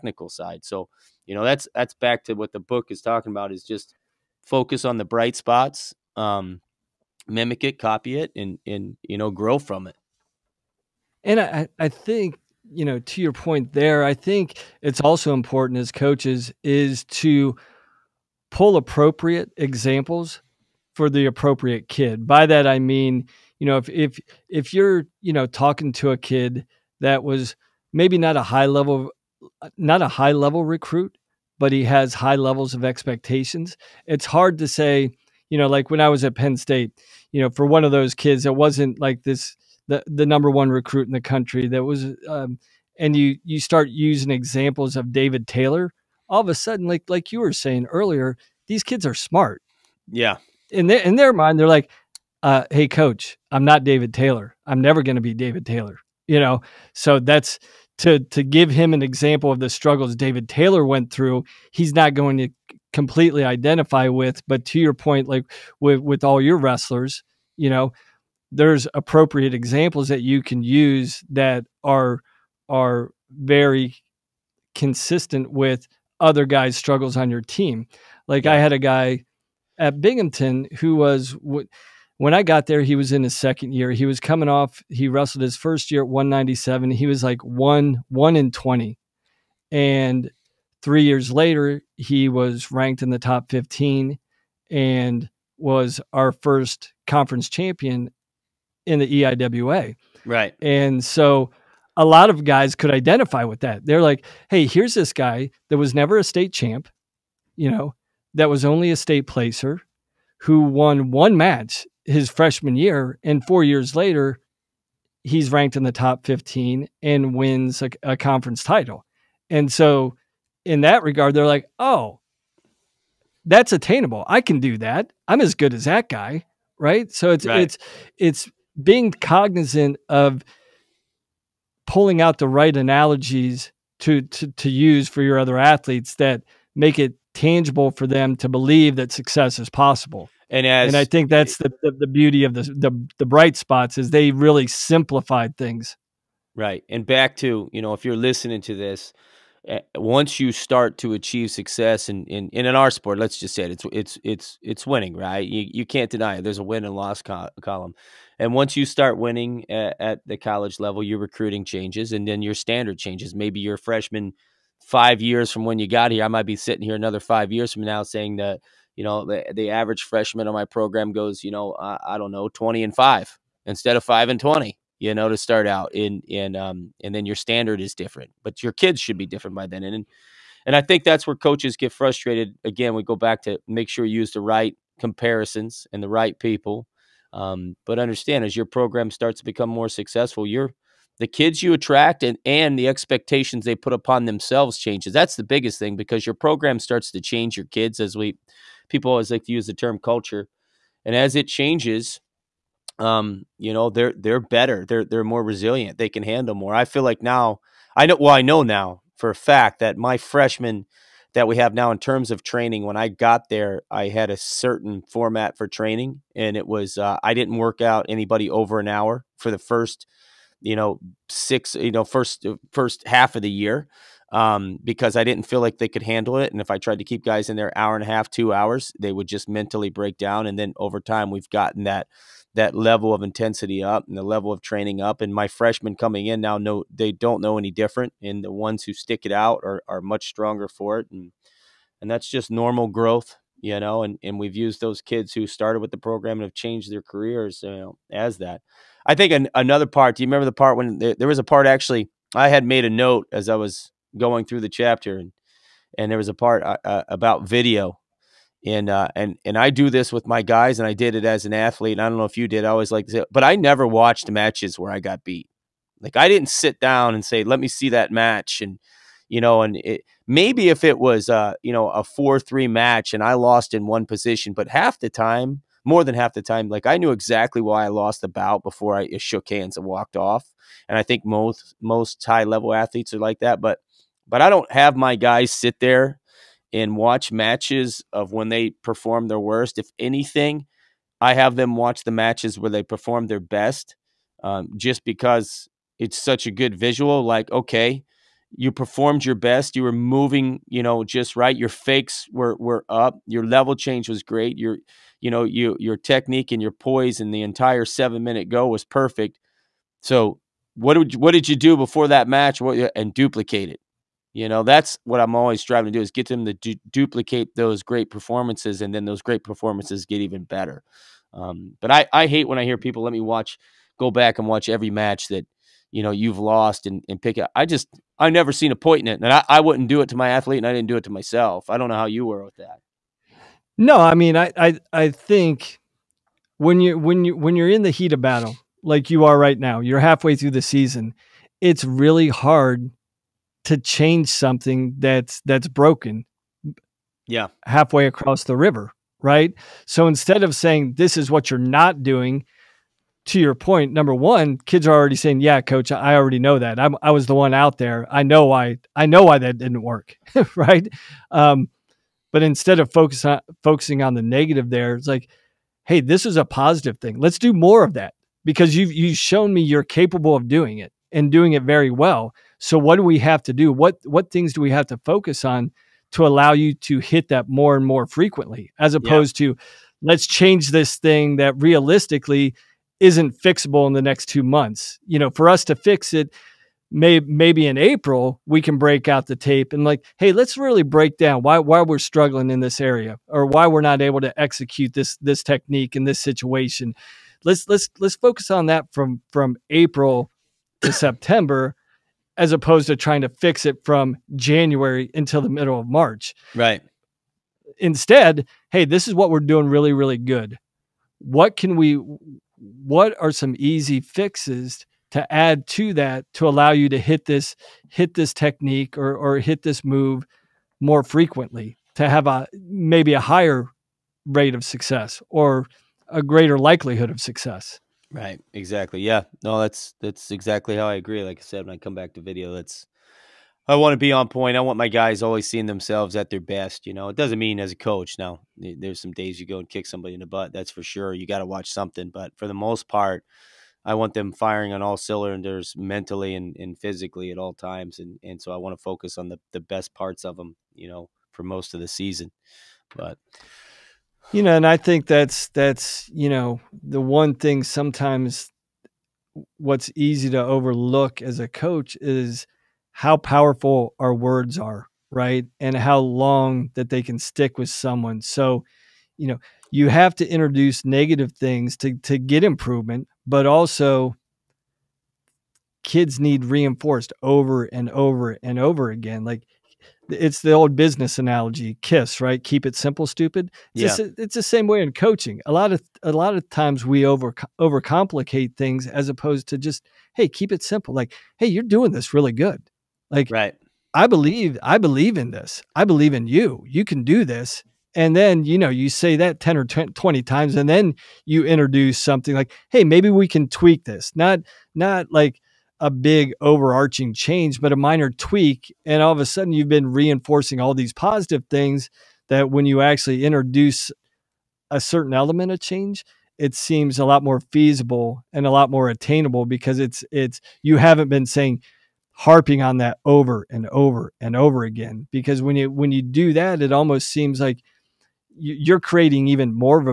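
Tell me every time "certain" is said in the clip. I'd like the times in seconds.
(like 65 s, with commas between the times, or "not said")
214 s, 514 s.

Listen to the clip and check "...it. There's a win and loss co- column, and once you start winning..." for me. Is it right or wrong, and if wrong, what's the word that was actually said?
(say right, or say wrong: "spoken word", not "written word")
right.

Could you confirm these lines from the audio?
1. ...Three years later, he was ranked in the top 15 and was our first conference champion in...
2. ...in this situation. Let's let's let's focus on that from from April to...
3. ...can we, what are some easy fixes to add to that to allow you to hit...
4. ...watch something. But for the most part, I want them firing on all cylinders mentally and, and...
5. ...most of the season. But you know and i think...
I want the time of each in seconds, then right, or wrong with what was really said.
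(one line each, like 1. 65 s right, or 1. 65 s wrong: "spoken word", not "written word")
1. 90 s right
2. 395 s right
3. 411 s right
4. 441 s right
5. 451 s right.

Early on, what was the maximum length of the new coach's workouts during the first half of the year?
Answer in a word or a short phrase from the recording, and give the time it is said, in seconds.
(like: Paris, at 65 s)
an hour, at 218 s.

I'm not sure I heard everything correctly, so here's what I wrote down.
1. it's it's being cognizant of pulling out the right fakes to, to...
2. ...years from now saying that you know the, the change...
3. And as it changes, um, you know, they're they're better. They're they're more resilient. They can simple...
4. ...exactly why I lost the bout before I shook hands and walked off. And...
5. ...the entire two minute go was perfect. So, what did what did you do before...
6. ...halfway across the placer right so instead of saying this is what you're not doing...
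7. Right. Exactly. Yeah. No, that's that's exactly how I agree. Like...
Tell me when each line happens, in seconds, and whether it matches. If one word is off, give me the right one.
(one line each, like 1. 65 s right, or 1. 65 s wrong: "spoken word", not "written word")
1. 127 s wrong: "analogies", not "fakes"
2. 167 s wrong: "average", not "change"
3. 201 s wrong: "handle", not "simple"
4. 277 s right
5. 307 s wrong: "seven", not "two"
6. 347 s wrong: "river", not "placer"
7. 428 s right.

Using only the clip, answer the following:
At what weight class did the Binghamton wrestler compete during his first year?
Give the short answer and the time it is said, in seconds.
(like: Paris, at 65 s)
197, at 86 s.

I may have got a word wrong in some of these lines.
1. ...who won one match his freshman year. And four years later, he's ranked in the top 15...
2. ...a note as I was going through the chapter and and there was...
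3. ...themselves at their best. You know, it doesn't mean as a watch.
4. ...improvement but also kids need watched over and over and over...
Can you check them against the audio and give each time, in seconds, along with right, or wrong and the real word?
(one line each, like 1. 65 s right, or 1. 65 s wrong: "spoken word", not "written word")
1. 110 s right
2. 252 s right
3. 435 s wrong: "coach", not "watch"
4. 472 s wrong: "reinforced", not "watched".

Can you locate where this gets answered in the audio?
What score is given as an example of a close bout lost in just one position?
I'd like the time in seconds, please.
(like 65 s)
272 s.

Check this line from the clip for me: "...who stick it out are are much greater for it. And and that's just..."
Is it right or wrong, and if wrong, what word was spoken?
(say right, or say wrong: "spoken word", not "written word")
wrong: "stronger", not "greater".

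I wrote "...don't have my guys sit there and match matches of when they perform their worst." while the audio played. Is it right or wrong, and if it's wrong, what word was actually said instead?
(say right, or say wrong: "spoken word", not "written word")
wrong: "watch", not "match".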